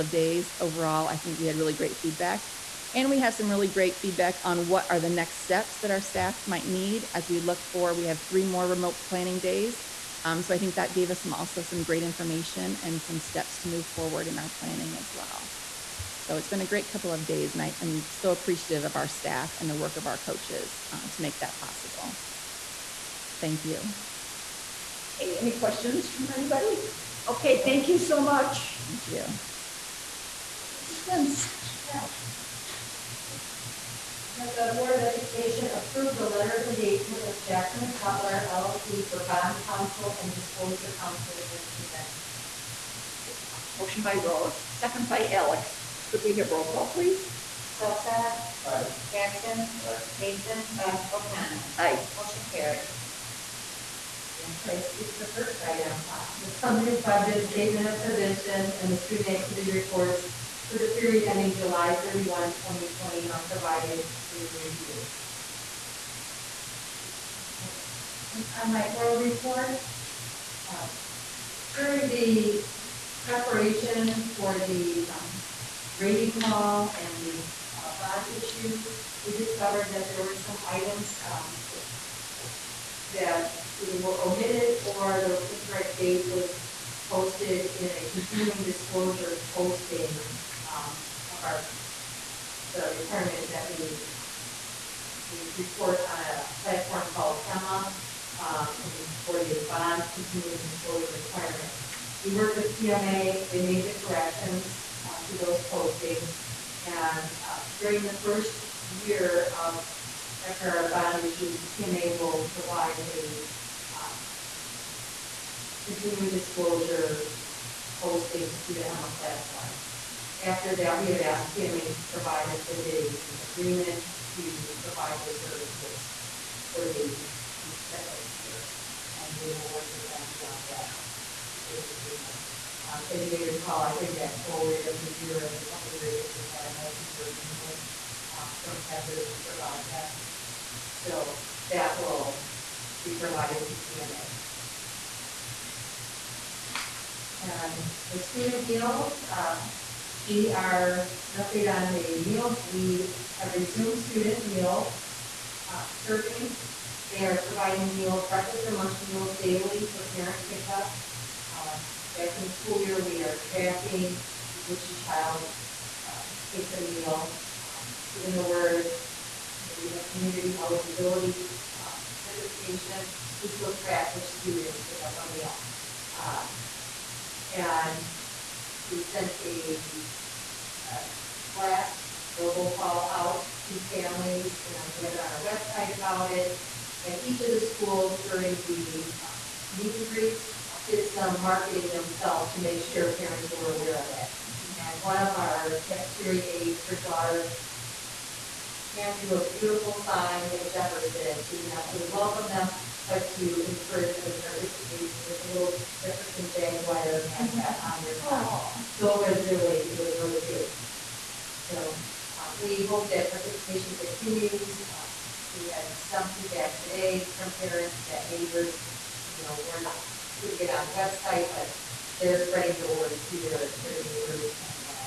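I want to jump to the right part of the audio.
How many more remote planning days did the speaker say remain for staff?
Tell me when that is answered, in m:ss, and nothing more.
0:08.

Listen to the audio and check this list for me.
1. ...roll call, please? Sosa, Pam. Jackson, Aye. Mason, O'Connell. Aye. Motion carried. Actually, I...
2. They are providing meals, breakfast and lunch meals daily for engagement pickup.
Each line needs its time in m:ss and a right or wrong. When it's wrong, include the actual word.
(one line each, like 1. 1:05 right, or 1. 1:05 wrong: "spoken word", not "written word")
1. 0:46 wrong: "Aye", not "Pam"
2. 2:37 wrong: "parent", not "engagement".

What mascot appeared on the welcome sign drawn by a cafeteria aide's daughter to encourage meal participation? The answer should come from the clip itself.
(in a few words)
Jefferson Jaguar.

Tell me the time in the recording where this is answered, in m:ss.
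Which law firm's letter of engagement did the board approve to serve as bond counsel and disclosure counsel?
0:37.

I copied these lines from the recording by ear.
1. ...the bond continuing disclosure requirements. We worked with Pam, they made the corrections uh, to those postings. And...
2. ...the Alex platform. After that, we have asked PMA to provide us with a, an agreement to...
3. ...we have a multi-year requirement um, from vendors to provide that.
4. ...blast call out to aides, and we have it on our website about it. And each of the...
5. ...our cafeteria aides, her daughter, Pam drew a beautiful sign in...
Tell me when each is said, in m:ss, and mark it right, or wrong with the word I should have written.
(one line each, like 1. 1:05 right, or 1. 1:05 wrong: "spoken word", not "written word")
1. 1:39 wrong: "PMA", not "Pam"
2. 1:58 wrong: "EMMA", not "Alex"
3. 2:16 wrong: "agreement", not "requirement"
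4. 3:01 wrong: "families", not "aides"
5. 3:15 right.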